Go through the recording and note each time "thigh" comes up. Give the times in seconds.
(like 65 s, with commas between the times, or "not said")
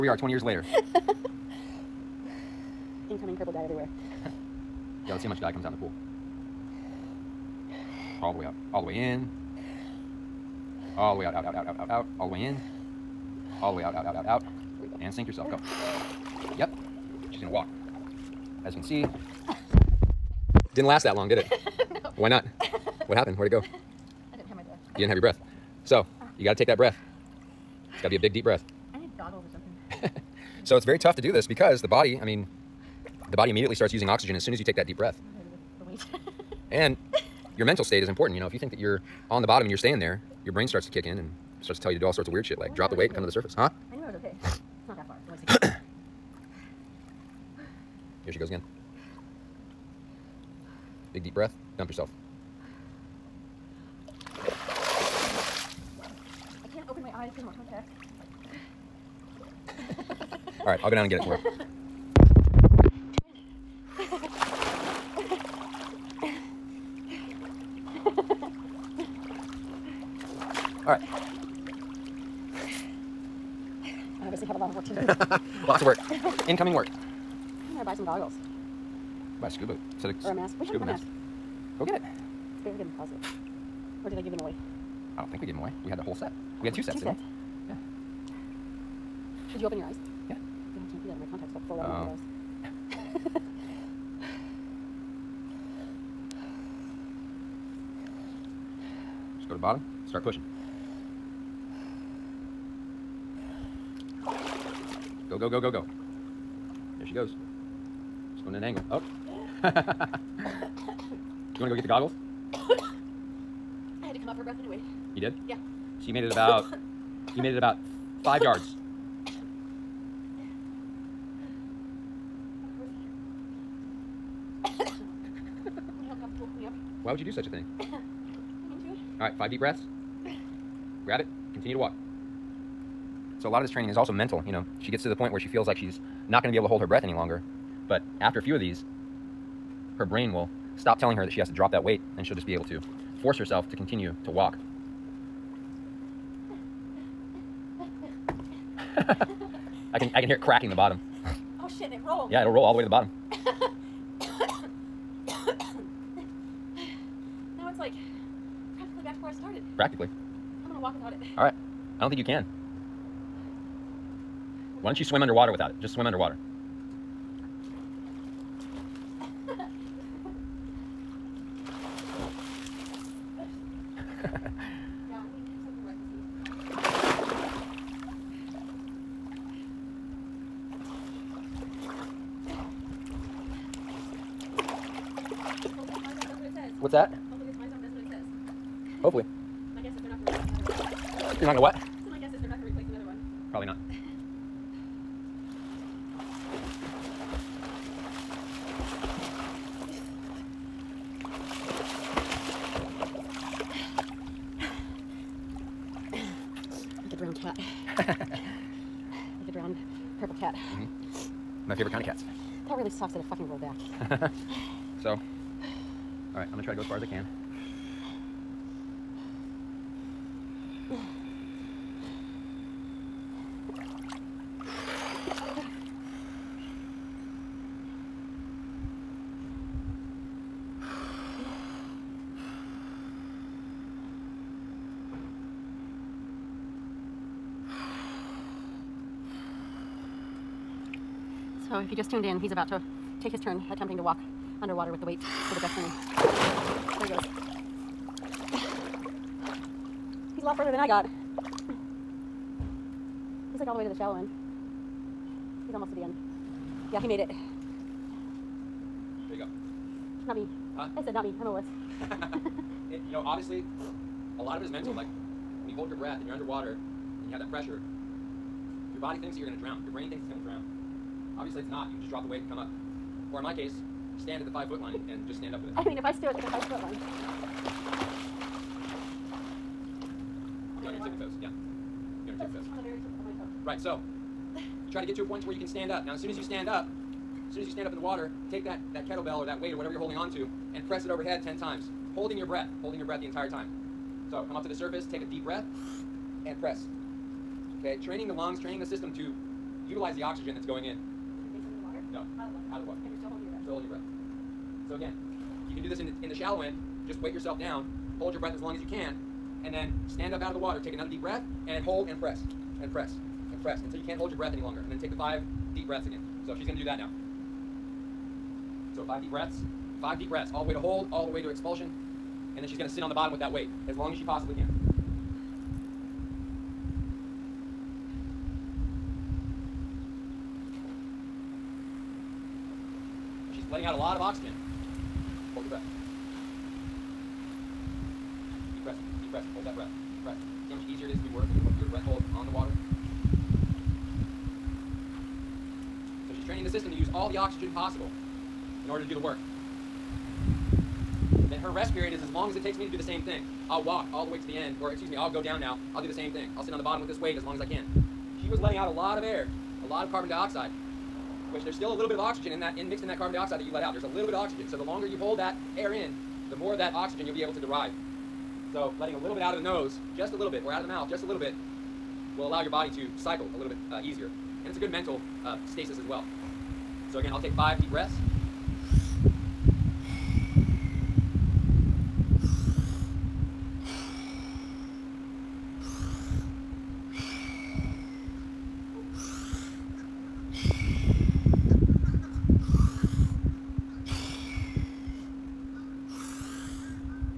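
not said.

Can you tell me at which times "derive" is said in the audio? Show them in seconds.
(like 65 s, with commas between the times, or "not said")
367 s.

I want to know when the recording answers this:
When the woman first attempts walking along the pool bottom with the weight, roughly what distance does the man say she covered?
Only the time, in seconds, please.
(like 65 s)
118 s.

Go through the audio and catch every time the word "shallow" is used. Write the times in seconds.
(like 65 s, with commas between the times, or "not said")
253 s, 306 s.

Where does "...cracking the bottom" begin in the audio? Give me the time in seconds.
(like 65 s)
150 s.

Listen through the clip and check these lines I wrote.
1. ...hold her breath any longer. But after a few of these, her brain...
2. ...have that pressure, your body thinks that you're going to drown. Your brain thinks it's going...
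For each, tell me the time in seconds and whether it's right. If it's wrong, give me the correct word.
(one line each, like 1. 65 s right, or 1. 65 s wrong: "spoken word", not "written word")
1. 136 s right
2. 267 s right.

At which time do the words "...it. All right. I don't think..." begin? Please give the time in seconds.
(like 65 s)
161 s.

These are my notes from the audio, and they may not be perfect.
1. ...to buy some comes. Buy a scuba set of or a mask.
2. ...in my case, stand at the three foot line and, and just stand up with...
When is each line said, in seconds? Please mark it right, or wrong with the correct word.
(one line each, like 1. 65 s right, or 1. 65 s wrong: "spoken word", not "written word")
1. 77 s wrong: "goggles", not "comes"
2. 273 s wrong: "five", not "three".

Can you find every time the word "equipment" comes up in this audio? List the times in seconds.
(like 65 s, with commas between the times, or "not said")
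not said.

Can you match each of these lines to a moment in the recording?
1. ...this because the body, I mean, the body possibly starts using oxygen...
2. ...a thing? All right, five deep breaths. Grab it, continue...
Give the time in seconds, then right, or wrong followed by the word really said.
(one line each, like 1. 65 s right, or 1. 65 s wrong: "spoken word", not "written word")
1. 31 s wrong: "immediately", not "possibly"
2. 127 s right.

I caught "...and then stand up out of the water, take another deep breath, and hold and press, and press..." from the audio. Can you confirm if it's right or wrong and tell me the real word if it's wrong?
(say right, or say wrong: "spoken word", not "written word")
right.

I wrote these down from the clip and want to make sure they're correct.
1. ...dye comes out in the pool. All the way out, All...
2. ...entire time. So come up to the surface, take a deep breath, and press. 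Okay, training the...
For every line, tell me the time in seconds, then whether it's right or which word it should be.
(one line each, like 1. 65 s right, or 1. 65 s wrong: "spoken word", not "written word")
1. 5 s right
2. 293 s right.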